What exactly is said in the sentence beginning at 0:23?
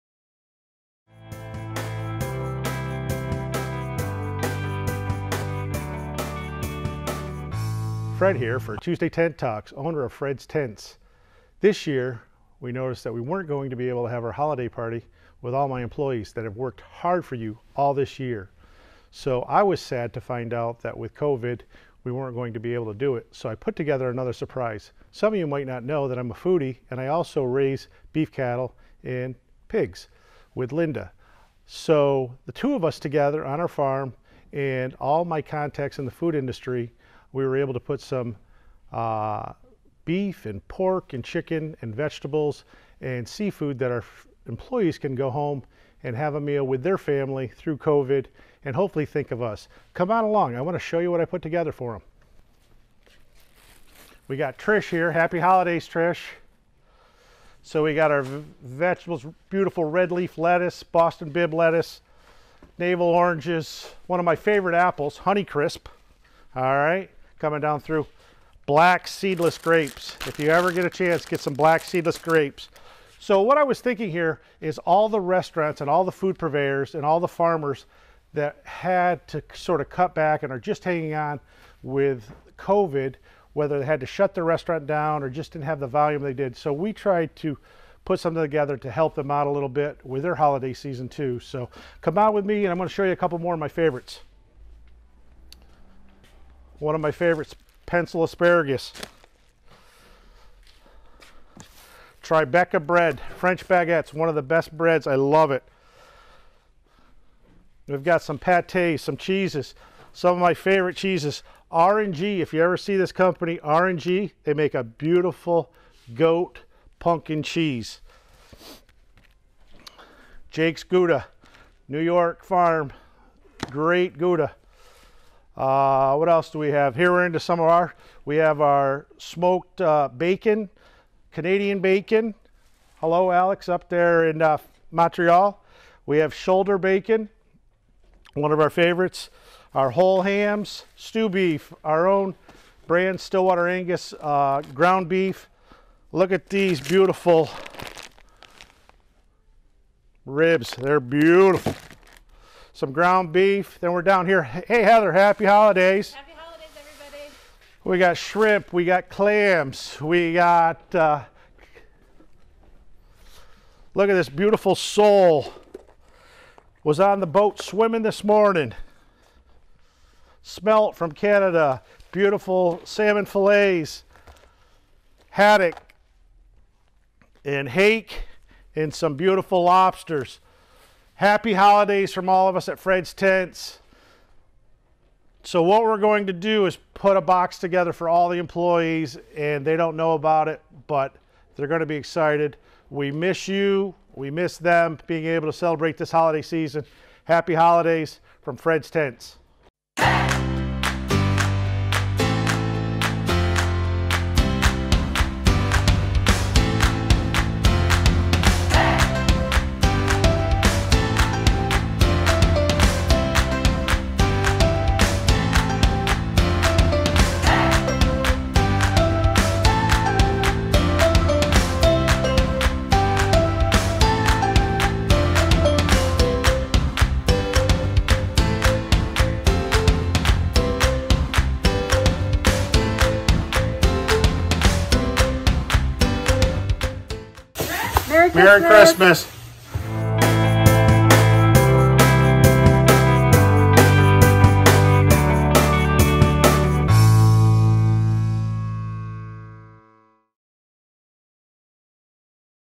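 So I put together another surprise.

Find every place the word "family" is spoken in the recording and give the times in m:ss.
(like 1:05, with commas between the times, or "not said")
0:46.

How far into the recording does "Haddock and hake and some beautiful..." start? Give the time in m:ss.
2:55.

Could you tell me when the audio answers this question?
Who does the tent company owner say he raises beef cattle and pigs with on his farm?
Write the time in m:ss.
0:30.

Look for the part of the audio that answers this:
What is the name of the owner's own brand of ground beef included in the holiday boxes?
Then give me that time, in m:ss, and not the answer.
2:23.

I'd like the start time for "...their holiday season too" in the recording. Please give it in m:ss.
1:30.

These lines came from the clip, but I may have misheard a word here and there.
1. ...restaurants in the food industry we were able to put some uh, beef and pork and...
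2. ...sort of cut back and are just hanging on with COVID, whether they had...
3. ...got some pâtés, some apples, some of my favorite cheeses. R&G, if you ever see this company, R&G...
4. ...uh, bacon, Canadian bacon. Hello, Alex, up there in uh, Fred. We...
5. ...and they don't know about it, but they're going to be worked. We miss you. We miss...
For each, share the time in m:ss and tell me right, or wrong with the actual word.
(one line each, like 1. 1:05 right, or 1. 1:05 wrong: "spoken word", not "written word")
1. 0:35 wrong: "contacts", not "restaurants"
2. 1:19 right
3. 1:48 wrong: "cheeses", not "apples"
4. 2:09 wrong: "Montreal", not "Fred"
5. 3:09 wrong: "excited", not "worked".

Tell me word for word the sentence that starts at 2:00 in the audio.
Jake's Gouda, New York Farm, great Gouda.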